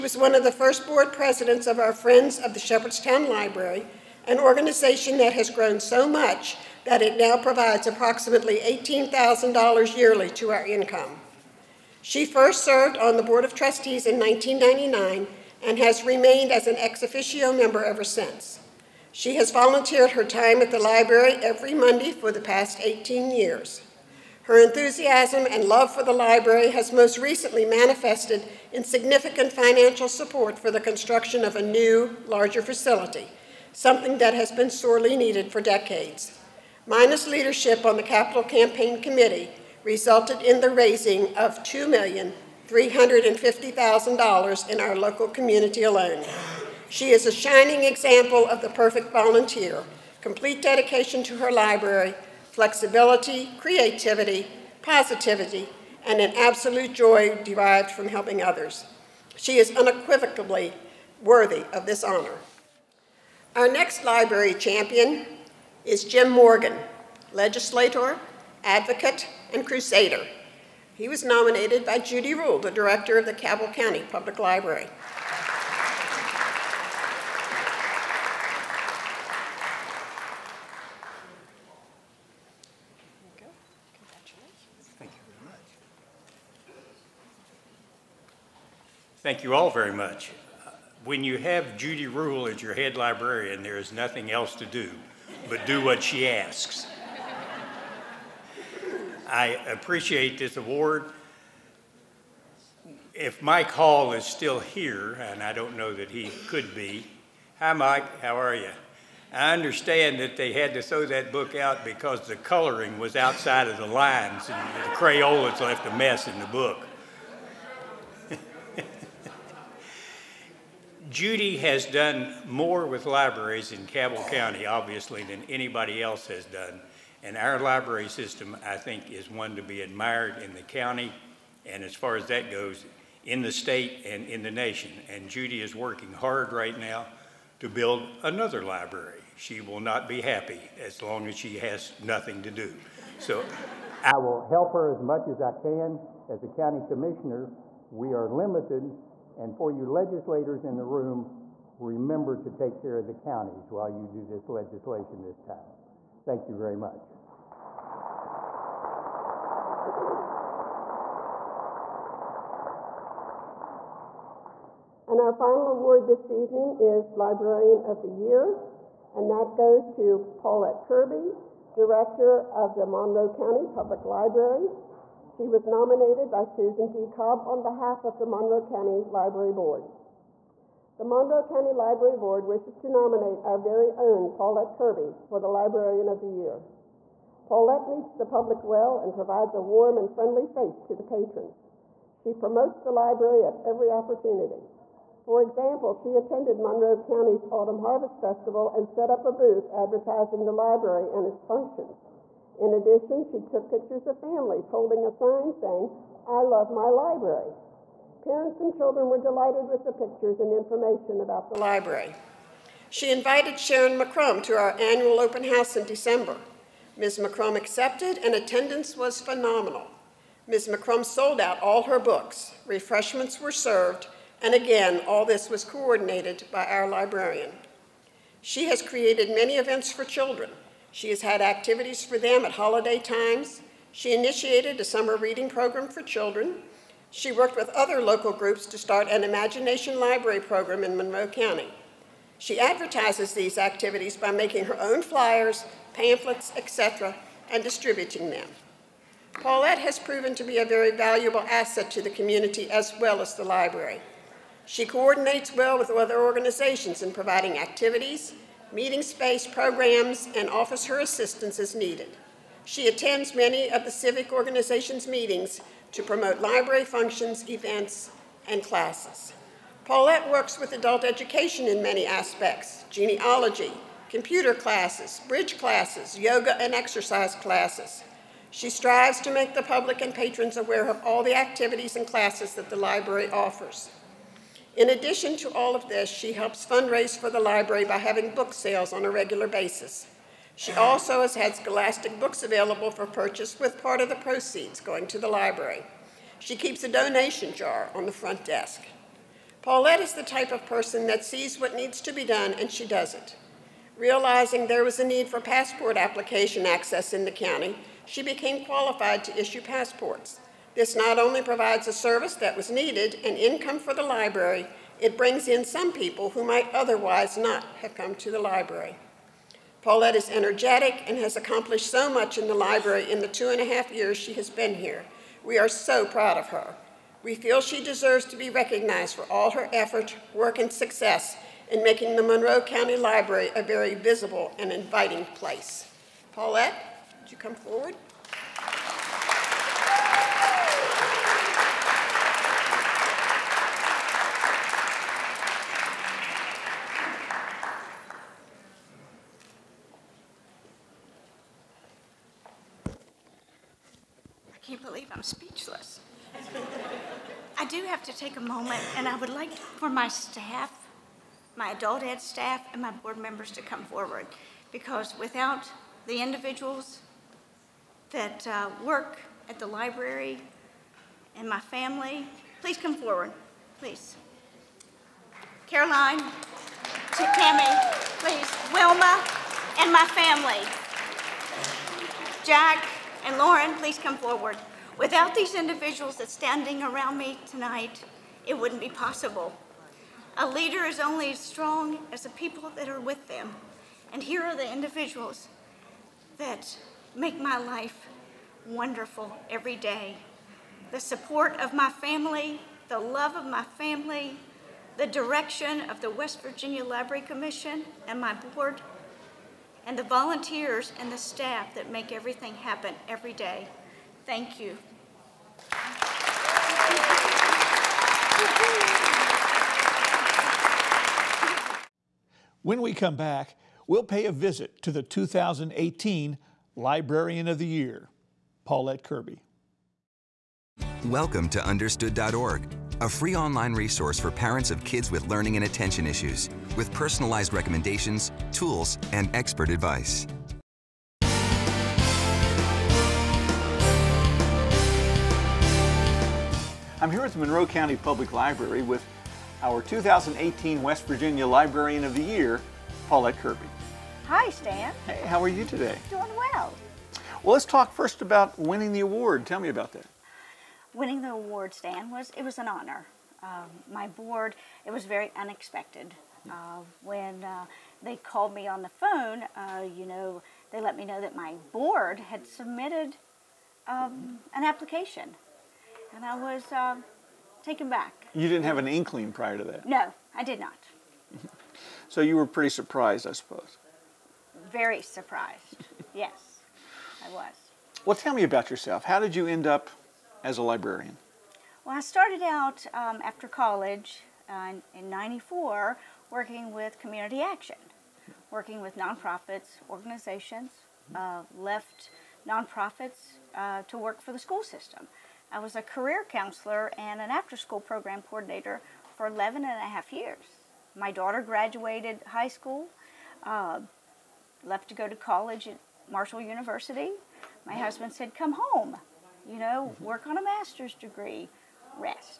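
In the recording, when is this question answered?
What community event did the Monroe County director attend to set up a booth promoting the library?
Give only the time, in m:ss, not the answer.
3:17.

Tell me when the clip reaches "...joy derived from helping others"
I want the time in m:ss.
0:56.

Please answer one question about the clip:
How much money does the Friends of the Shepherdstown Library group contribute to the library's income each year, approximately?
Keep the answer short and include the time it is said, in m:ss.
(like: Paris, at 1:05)
$18,000, at 0:08.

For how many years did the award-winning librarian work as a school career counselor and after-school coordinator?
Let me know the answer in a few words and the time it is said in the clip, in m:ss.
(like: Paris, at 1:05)
11 and a half years, at 8:29.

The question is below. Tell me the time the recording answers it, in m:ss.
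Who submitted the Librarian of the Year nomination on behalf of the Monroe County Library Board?
2:56.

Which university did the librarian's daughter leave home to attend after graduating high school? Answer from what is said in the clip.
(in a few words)
Marshall University.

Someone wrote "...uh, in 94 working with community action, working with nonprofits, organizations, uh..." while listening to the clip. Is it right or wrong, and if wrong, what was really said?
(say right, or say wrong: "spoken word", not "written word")
right.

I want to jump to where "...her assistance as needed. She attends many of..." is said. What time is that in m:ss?
4:20.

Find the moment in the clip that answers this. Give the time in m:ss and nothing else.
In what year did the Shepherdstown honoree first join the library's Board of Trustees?
0:14.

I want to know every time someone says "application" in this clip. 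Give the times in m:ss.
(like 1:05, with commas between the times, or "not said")
5:05, 7:54.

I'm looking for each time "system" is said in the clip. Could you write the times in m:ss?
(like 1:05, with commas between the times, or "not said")
2:08, 8:24.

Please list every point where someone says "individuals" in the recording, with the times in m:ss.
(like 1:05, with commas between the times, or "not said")
6:06, 6:25, 6:34.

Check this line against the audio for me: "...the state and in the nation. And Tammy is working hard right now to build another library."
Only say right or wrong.
wrong.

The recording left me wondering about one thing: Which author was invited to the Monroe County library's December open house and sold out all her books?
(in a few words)
Sharyn McCrumb.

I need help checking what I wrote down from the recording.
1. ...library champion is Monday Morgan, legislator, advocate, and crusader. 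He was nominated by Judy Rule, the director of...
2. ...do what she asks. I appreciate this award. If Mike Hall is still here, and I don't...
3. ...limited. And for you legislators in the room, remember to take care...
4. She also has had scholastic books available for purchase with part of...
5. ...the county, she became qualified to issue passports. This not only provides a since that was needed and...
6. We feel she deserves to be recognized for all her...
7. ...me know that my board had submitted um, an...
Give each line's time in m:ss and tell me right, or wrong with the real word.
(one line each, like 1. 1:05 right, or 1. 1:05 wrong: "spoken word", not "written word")
1. 1:04 wrong: "Jim", not "Monday"
2. 1:35 right
3. 2:28 right
4. 4:50 right
5. 5:07 wrong: "service", not "since"
6. 5:27 right
7. 7:50 right.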